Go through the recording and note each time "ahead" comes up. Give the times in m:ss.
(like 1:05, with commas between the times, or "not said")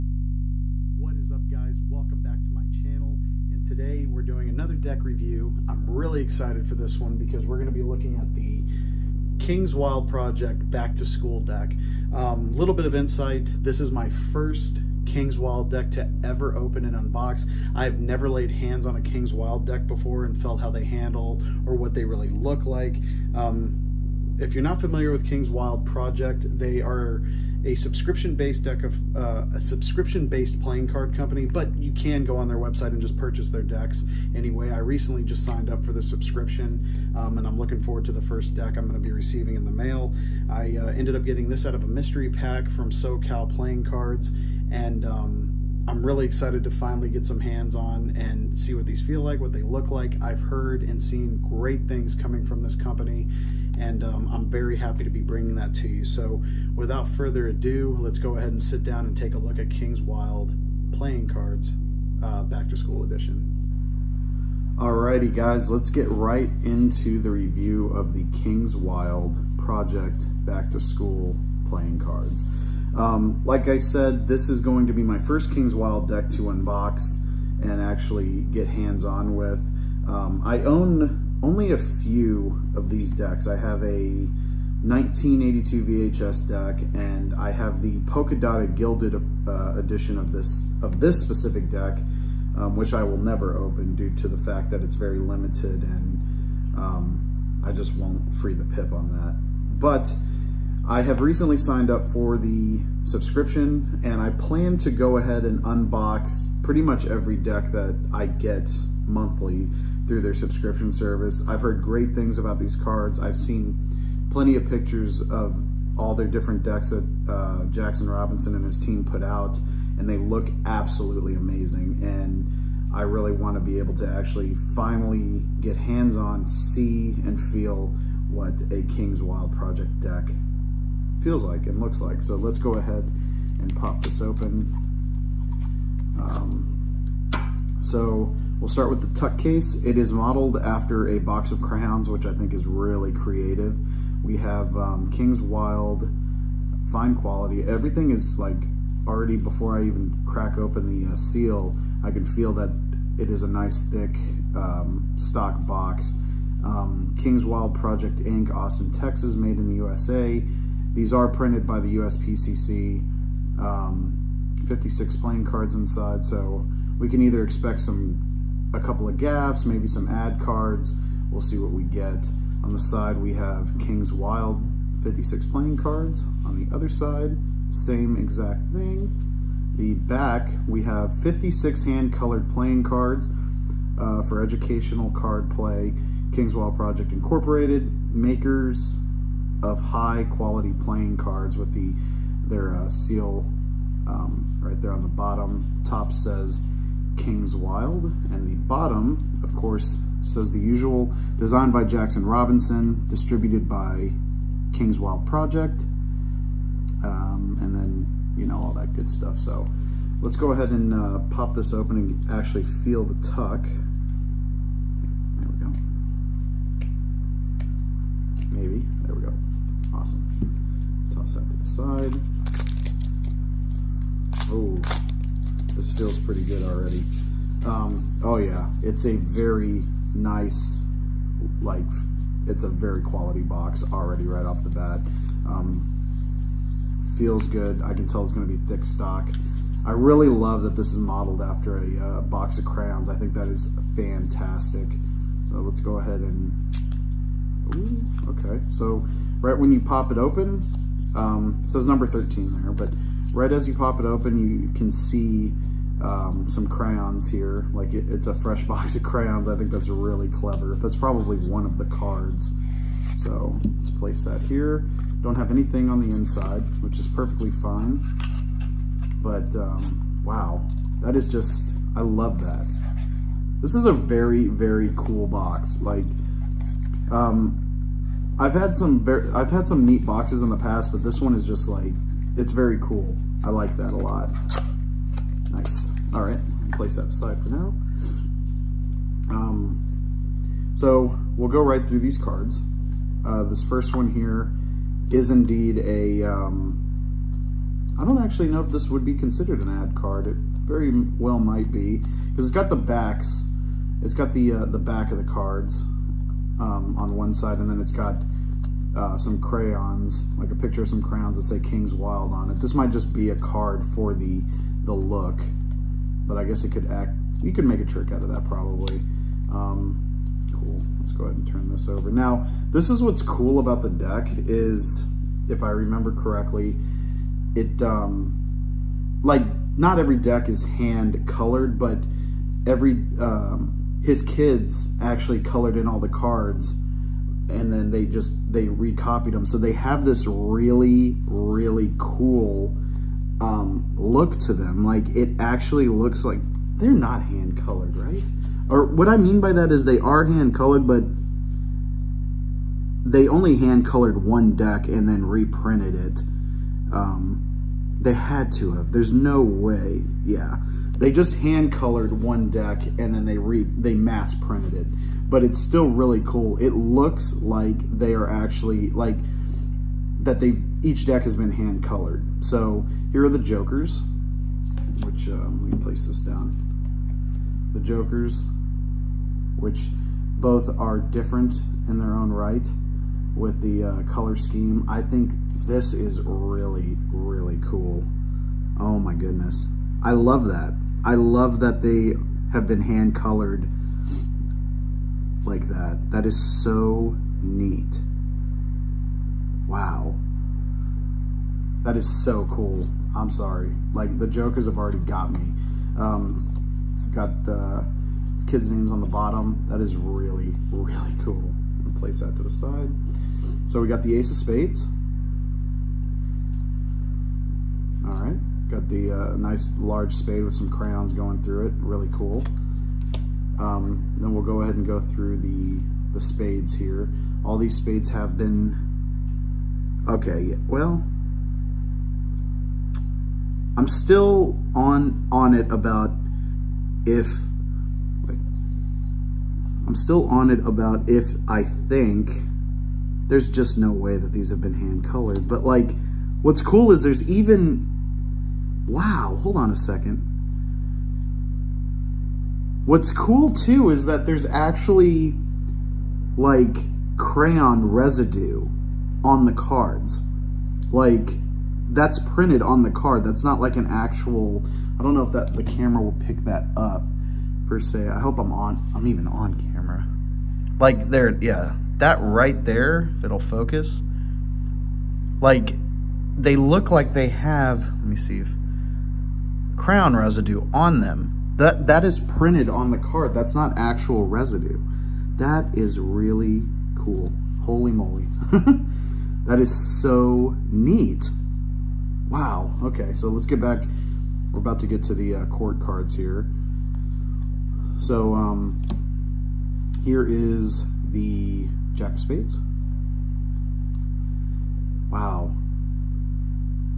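0:58, 1:45, 2:12, 3:30, 4:05, 5:21, 7:04.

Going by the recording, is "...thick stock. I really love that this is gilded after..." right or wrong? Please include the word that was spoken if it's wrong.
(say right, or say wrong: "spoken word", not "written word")
wrong: "modeled", not "gilded".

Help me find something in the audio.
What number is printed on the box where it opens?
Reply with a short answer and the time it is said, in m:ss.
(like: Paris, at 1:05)
13, at 4:11.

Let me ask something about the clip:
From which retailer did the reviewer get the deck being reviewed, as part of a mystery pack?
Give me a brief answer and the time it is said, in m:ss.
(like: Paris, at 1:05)
SoCal Playing Cards, at 0:42.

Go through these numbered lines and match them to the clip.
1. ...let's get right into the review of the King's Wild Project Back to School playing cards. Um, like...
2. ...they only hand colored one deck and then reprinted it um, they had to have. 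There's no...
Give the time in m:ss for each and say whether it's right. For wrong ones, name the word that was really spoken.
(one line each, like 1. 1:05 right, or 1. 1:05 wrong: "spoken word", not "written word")
1. 1:05 right
2. 5:53 right.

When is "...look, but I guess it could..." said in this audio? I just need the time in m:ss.
5:14.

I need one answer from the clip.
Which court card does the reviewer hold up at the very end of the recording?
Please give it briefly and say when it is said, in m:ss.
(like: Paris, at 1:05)
Jack of Spades, at 8:21.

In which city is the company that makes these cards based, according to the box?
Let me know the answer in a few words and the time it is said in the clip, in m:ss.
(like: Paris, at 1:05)
Austin, Texas, at 2:38.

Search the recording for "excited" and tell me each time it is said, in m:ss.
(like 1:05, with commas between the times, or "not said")
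0:06, 0:46.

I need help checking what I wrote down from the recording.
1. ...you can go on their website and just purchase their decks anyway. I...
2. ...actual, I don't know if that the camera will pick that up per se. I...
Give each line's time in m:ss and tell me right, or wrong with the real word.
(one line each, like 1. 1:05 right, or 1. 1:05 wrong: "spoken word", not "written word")
1. 0:31 right
2. 7:43 right.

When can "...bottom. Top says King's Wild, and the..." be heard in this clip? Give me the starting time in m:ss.
3:15.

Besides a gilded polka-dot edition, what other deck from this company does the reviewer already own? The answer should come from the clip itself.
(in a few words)
1982 VHS deck.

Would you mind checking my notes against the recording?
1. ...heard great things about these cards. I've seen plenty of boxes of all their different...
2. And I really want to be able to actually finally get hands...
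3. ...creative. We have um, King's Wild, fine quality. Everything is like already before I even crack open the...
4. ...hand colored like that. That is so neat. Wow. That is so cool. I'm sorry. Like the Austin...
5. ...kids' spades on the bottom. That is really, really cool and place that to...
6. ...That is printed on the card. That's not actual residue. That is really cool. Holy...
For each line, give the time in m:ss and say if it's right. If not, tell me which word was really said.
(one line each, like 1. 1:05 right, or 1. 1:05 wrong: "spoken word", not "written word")
1. 1:51 wrong: "pictures", not "boxes"
2. 2:02 right
3. 2:23 right
4. 6:32 wrong: "Jokers", not "Austin"
5. 6:48 wrong: "names", not "spades"
6. 8:01 right.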